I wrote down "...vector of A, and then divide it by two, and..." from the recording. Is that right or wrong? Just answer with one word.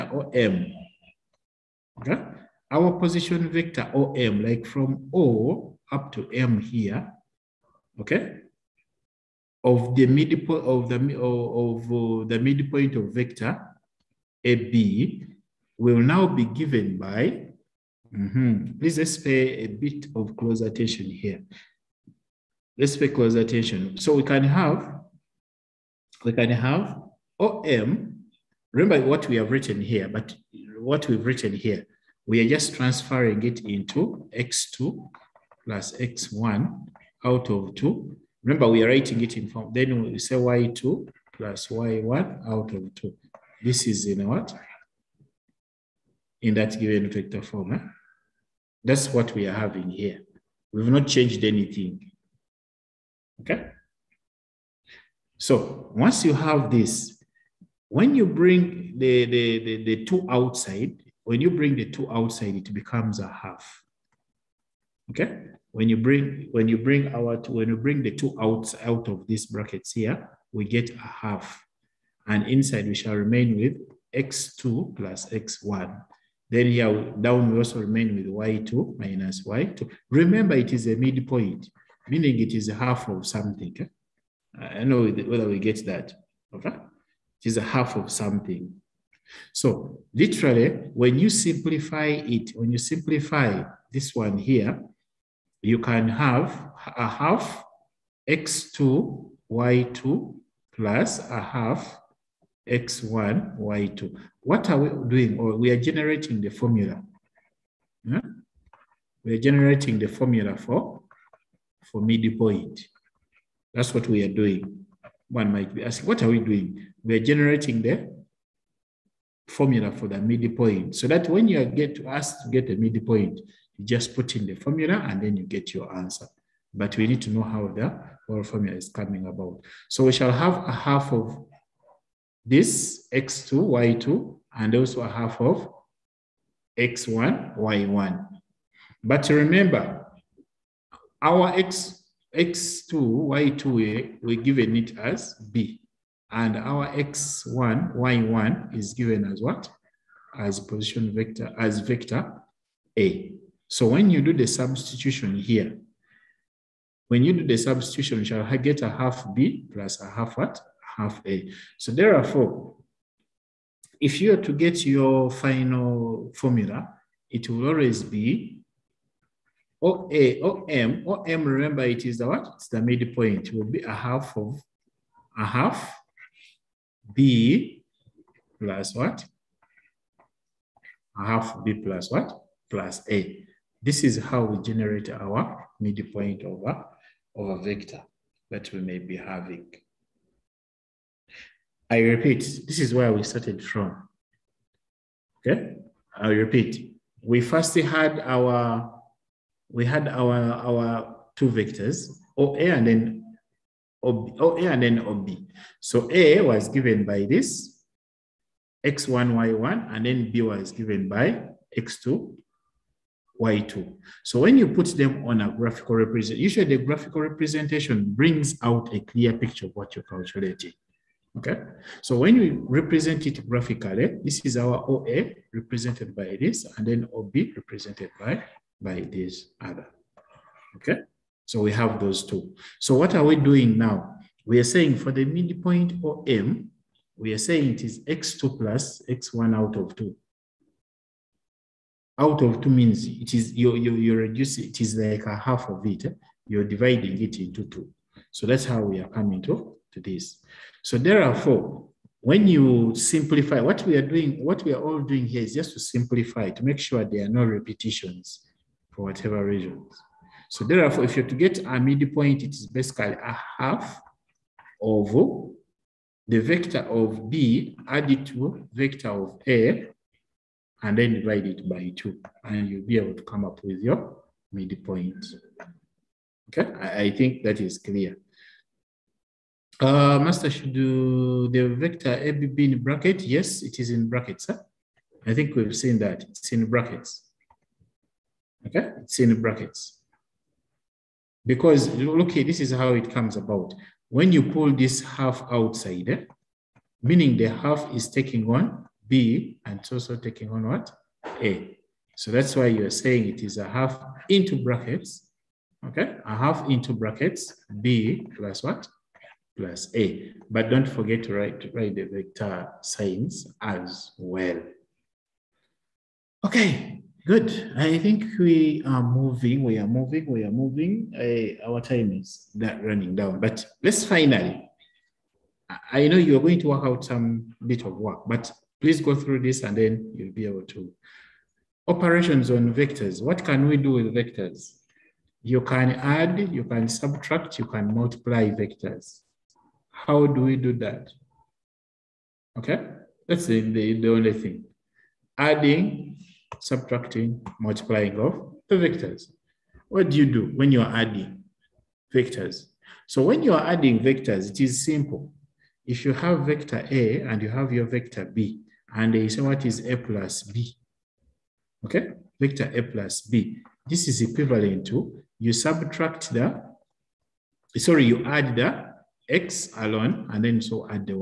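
right.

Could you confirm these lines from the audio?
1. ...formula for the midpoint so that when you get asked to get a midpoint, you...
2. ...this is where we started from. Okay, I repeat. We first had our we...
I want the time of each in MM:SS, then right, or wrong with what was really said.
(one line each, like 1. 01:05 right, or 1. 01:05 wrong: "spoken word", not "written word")
1. 01:59 right
2. 03:12 right.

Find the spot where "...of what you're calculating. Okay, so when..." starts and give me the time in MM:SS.
03:39.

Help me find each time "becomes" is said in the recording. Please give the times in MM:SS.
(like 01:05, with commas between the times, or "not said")
01:02.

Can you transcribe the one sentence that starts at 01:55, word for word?
One might be asking, what are we doing?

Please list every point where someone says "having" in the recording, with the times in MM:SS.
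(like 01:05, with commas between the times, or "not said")
00:49, 03:09.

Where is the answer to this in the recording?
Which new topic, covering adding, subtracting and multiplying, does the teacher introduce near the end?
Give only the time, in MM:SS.
05:31.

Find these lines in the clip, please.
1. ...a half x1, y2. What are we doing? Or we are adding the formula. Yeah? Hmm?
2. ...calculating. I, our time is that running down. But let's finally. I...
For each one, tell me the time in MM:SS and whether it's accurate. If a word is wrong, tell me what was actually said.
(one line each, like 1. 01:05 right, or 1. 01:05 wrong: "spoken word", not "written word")
1. 01:41 wrong: "generating", not "adding"
2. 05:20 wrong: "moving", not "calculating".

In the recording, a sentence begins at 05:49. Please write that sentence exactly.
What do you do when you're adding vectors?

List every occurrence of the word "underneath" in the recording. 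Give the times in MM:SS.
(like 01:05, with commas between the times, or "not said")
not said.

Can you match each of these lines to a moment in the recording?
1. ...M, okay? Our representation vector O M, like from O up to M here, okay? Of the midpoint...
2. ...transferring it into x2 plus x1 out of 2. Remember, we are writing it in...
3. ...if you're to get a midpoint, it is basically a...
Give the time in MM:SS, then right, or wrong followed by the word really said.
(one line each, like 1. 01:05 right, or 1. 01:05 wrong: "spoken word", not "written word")
1. 00:00 wrong: "position", not "representation"
2. 00:32 right
3. 04:21 right.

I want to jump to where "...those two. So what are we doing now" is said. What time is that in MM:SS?
03:51.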